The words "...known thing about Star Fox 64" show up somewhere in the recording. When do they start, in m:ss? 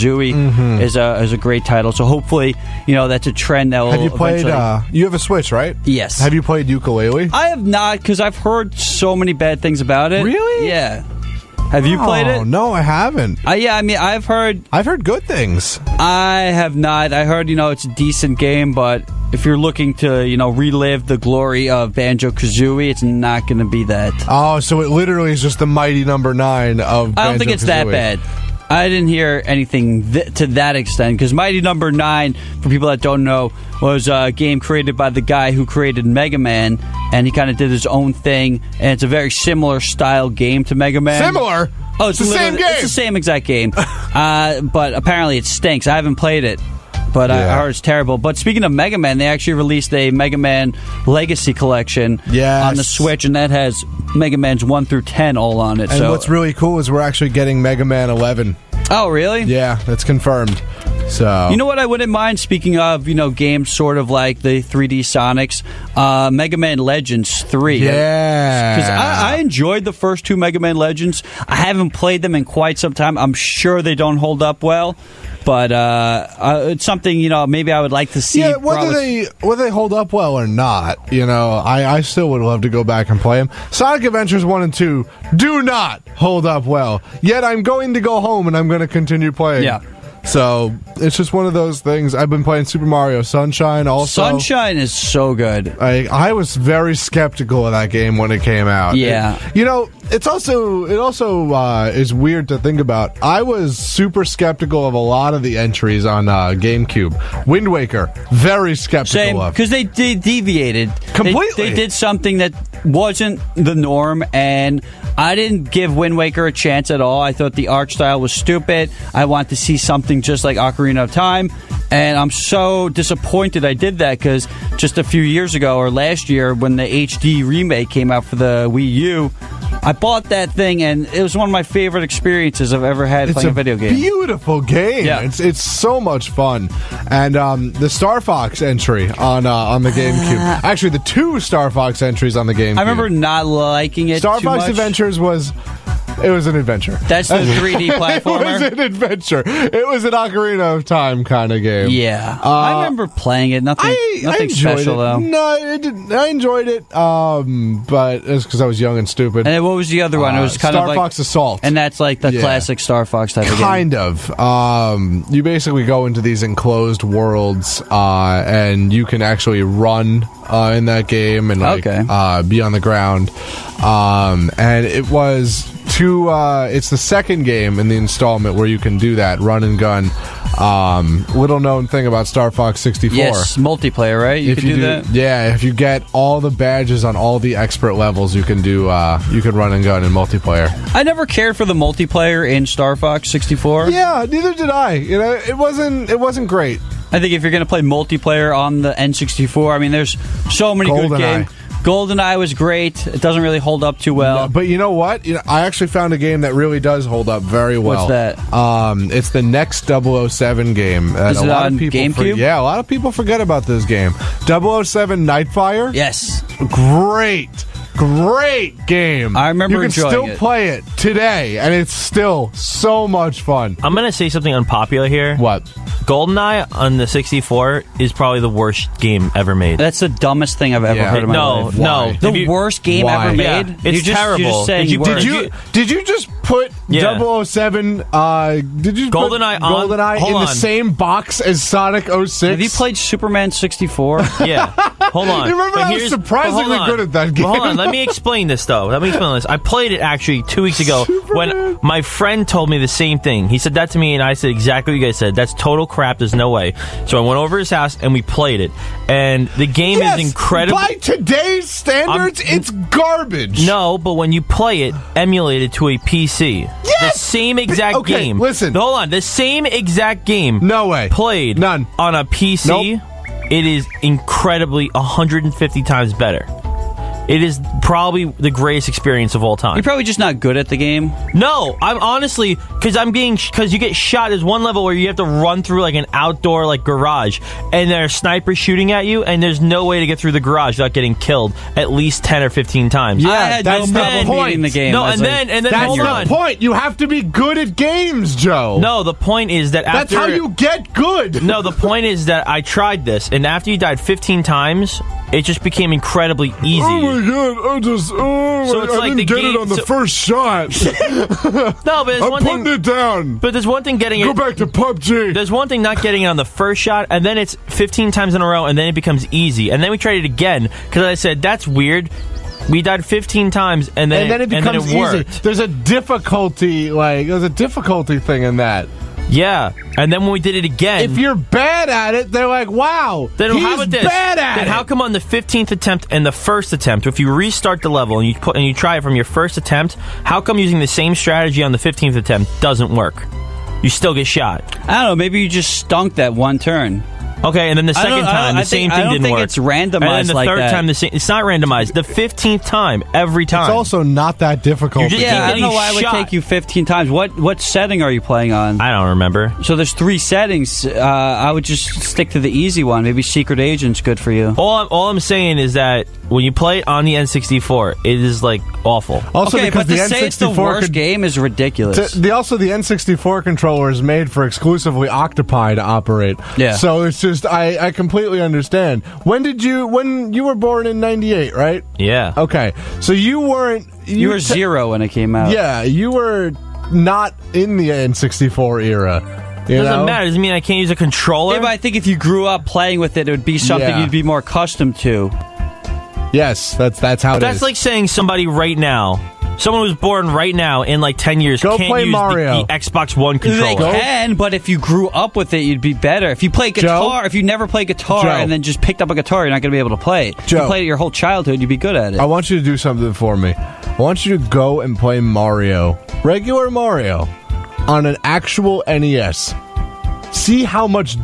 3:01.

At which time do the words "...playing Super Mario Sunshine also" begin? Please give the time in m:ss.
1:32.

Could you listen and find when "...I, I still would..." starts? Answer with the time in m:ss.
1:21.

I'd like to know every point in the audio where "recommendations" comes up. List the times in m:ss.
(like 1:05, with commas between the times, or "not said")
not said.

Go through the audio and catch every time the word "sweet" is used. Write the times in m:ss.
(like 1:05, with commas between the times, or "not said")
not said.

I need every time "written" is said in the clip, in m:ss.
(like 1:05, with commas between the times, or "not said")
not said.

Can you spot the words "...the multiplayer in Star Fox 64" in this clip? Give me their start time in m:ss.
3:11.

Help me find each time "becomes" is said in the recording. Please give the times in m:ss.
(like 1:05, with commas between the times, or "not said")
5:18, 5:24.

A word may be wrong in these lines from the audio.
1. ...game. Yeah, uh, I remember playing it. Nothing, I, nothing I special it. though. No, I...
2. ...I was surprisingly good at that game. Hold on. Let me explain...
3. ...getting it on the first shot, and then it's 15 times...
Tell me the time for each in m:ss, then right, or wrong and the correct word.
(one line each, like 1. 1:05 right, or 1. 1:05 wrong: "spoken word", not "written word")
1. 2:31 right
2. 4:05 right
3. 5:16 right.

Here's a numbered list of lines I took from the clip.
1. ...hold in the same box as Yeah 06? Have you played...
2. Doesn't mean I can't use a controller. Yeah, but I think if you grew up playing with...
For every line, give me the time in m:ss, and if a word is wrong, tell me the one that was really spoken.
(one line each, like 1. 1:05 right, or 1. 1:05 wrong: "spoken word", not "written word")
1. 4:00 wrong: "Sonic", not "Yeah"
2. 6:30 right.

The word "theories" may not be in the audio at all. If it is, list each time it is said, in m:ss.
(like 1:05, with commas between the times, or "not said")
not said.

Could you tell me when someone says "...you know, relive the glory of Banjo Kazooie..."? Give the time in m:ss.
0:20.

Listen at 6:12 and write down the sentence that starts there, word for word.
To, the, also, the N64 controller is made for exclusively Octopi to operate.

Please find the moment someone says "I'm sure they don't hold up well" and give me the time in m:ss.
1:13.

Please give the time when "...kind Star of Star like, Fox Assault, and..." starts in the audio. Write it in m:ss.
2:40.